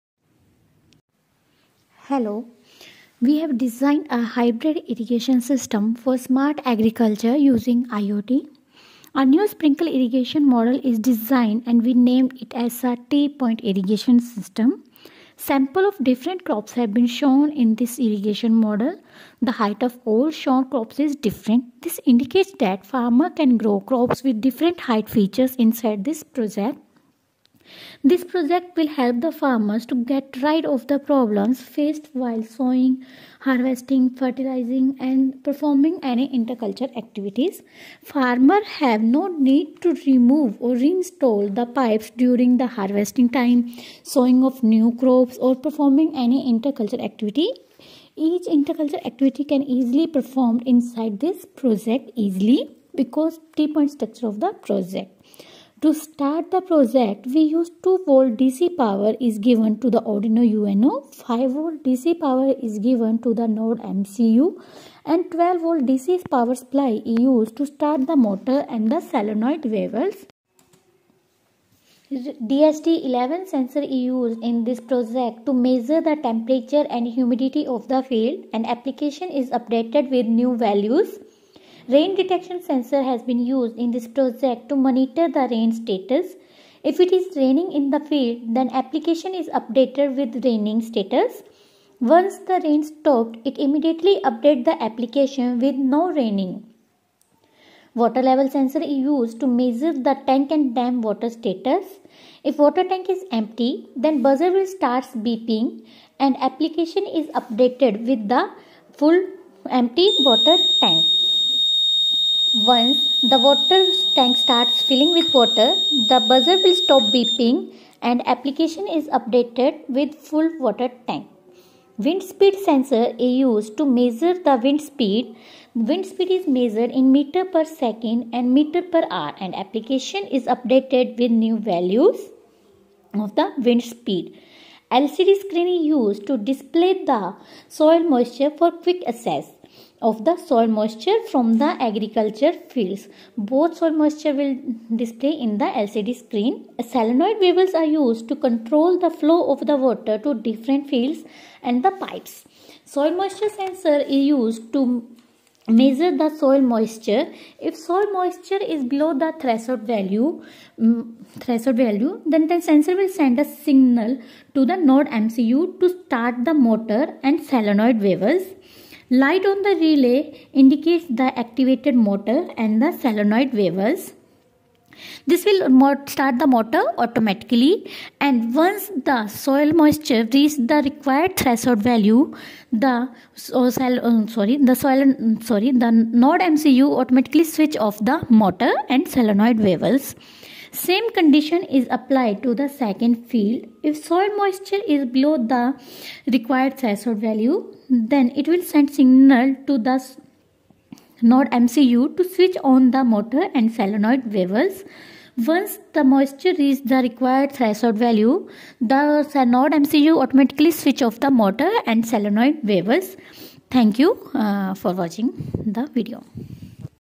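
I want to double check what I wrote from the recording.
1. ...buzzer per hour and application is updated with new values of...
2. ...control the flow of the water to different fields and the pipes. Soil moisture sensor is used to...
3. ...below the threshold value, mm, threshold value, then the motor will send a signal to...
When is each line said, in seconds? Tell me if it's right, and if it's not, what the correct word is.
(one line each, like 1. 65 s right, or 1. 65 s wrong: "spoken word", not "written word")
1. 128 s wrong: "meter", not "buzzer"
2. 148 s right
3. 158 s wrong: "sensor", not "motor".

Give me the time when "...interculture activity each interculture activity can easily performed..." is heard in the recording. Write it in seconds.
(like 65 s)
46 s.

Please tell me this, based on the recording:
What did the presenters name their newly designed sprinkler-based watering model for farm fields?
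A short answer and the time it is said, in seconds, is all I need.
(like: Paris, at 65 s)
T-point irrigation system, at 13 s.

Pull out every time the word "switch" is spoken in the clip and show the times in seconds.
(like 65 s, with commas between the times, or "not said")
187 s, 202 s, 210 s.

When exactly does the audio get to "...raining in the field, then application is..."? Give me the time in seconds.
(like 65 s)
87 s.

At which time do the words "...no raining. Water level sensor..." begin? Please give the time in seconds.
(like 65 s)
95 s.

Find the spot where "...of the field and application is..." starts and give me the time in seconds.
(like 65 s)
77 s.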